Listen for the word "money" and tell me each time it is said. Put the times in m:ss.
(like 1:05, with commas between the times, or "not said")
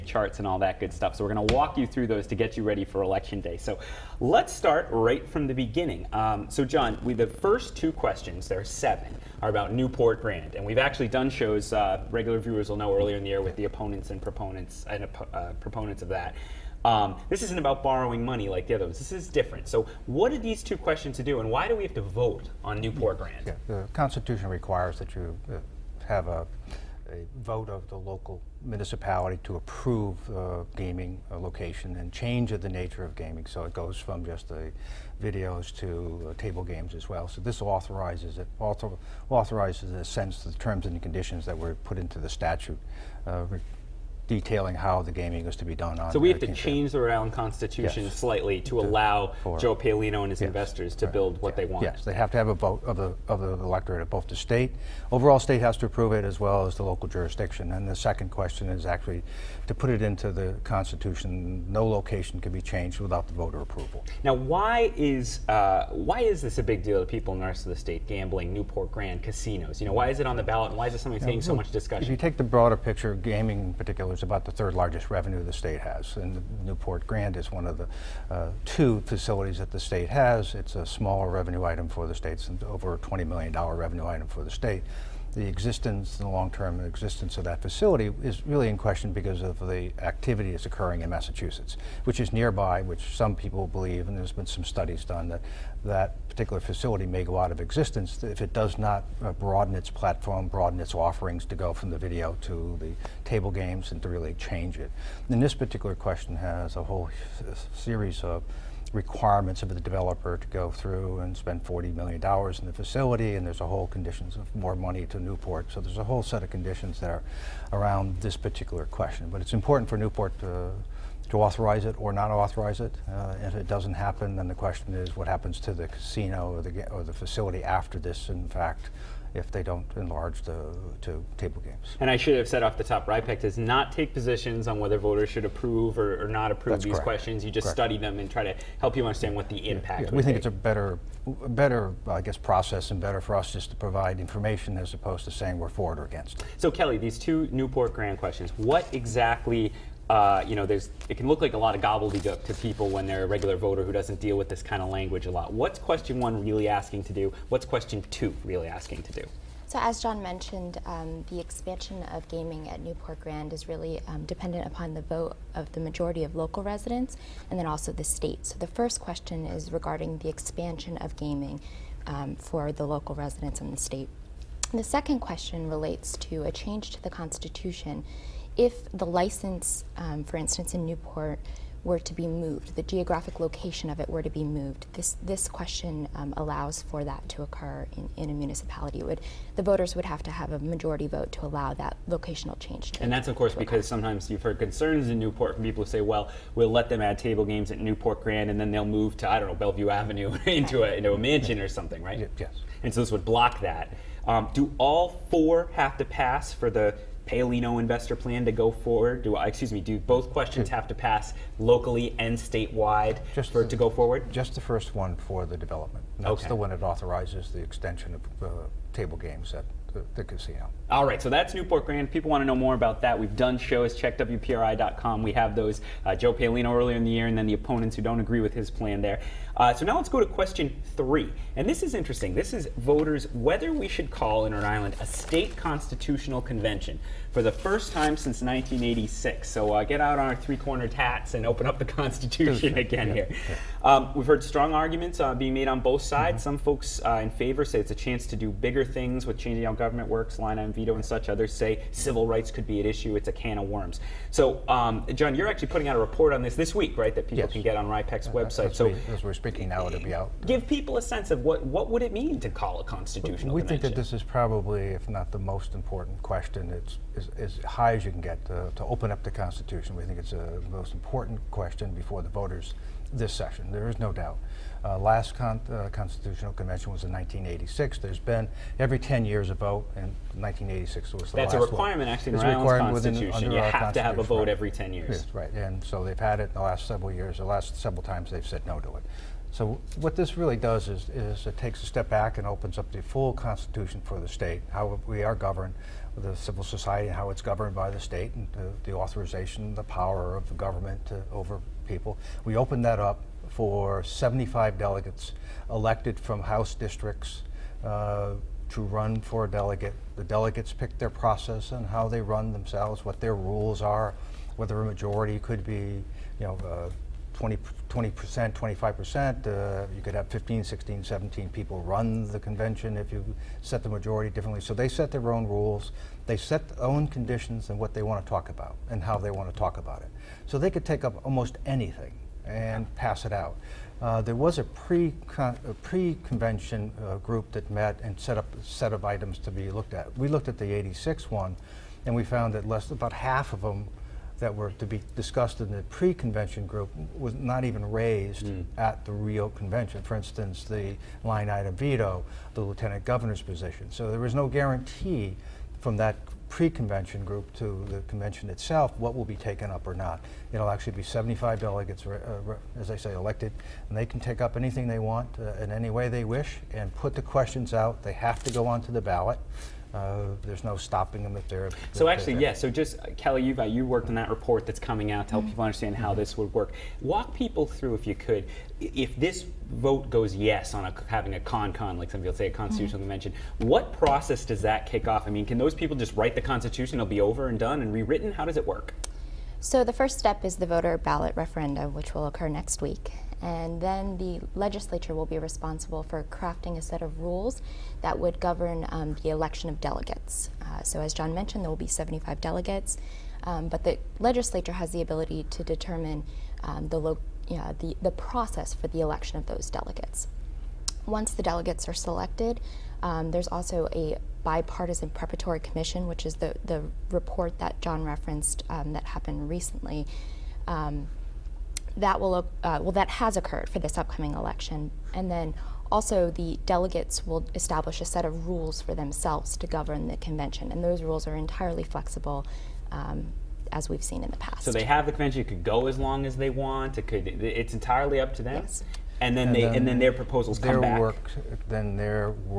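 0:18, 1:54.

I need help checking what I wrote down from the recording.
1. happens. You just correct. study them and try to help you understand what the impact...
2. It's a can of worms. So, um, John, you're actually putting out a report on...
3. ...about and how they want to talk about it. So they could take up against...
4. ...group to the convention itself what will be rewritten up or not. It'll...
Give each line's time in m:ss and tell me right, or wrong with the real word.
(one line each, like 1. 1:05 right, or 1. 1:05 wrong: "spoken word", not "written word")
1. 2:17 wrong: "questions", not "happens"
2. 4:13 right
3. 5:28 wrong: "almost", not "against"
4. 5:57 wrong: "taken", not "rewritten".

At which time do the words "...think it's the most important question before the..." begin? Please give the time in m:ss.
4:30.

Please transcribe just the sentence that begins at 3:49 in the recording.
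Uh, so now let's go to question three.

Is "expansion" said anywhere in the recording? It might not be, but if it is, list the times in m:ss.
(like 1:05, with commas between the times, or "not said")
2:41, 2:50.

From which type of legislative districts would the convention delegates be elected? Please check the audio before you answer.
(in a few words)
House districts.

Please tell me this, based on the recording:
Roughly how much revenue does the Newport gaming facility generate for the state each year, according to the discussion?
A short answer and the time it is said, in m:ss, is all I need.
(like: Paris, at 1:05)
over $20 million, at 1:22.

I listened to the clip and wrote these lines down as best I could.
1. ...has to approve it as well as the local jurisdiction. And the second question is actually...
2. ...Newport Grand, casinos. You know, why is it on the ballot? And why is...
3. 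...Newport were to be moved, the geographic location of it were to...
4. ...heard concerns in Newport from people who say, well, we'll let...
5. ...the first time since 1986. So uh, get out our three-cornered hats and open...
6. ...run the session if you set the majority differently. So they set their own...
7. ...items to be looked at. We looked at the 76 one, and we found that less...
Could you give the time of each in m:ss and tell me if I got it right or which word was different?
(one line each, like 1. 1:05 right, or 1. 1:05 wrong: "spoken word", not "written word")
1. 0:55 right
2. 1:08 right
3. 3:00 right
4. 3:14 right
5. 3:57 right
6. 5:21 wrong: "convention", not "session"
7. 5:39 wrong: "86", not "76".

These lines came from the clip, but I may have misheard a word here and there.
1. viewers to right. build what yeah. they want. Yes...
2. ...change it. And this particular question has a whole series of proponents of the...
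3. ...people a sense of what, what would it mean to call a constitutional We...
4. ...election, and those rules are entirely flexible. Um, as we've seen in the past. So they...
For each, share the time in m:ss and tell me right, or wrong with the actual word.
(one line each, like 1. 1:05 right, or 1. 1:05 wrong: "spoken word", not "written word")
1. 0:50 wrong: "investors", not "viewers"
2. 1:44 wrong: "requirements", not "proponents"
3. 4:20 right
4. 7:10 wrong: "convention", not "election".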